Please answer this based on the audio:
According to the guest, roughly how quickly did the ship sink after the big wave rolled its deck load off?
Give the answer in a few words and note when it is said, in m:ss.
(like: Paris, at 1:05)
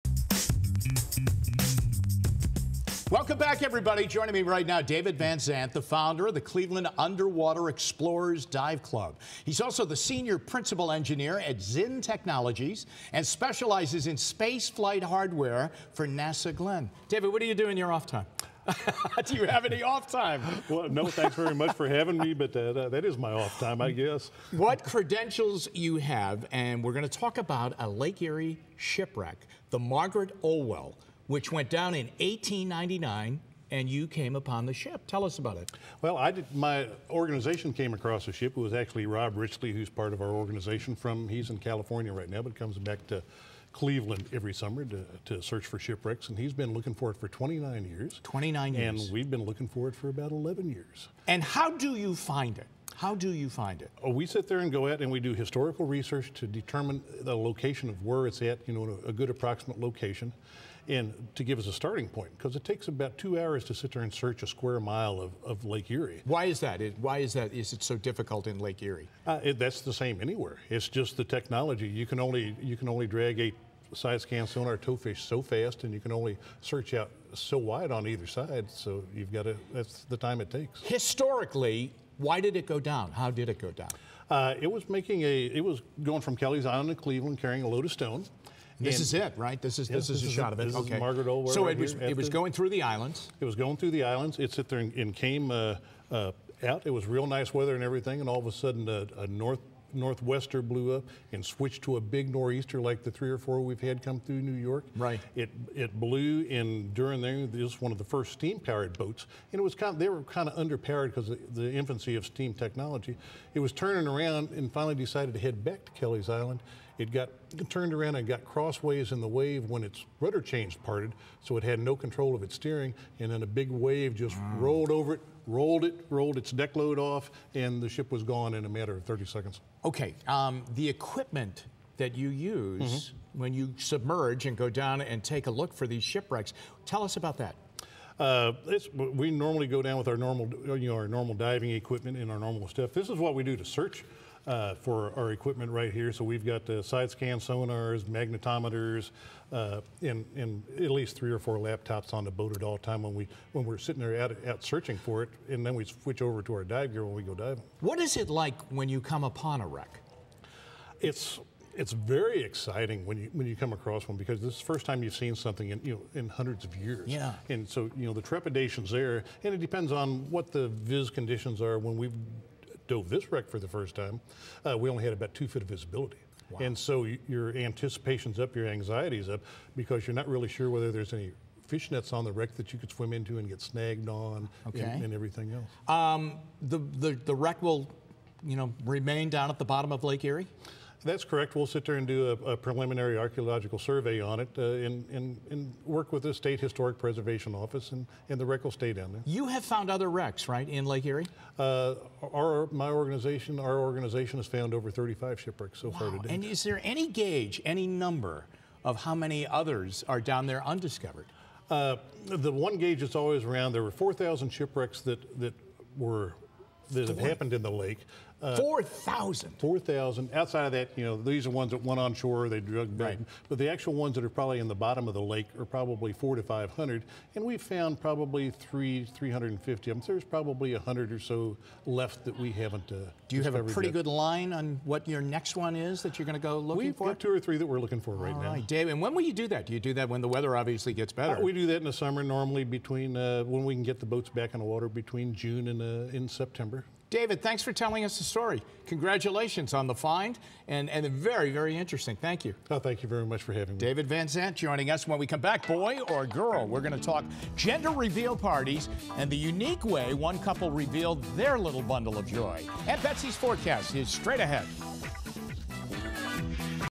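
30 seconds, at 2:09.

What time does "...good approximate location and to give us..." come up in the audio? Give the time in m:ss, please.
0:59.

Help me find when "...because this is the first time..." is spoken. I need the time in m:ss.
2:44.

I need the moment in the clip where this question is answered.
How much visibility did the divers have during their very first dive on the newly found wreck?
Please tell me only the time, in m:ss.
2:55.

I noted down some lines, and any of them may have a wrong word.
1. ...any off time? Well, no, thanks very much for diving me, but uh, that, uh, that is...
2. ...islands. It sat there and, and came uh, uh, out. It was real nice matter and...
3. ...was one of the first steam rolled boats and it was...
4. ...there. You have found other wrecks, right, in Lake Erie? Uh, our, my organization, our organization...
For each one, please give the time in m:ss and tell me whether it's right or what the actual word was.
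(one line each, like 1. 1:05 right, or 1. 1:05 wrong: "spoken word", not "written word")
1. 0:19 wrong: "having", not "diving"
2. 1:34 wrong: "weather", not "matter"
3. 1:47 wrong: "powered", not "rolled"
4. 3:19 right.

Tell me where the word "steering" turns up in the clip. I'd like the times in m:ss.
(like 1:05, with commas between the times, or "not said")
2:02.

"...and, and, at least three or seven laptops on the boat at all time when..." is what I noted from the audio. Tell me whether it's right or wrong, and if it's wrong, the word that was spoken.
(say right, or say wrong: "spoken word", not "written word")
wrong: "four", not "seven".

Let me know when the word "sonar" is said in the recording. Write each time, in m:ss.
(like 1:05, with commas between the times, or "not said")
1:14, 2:27.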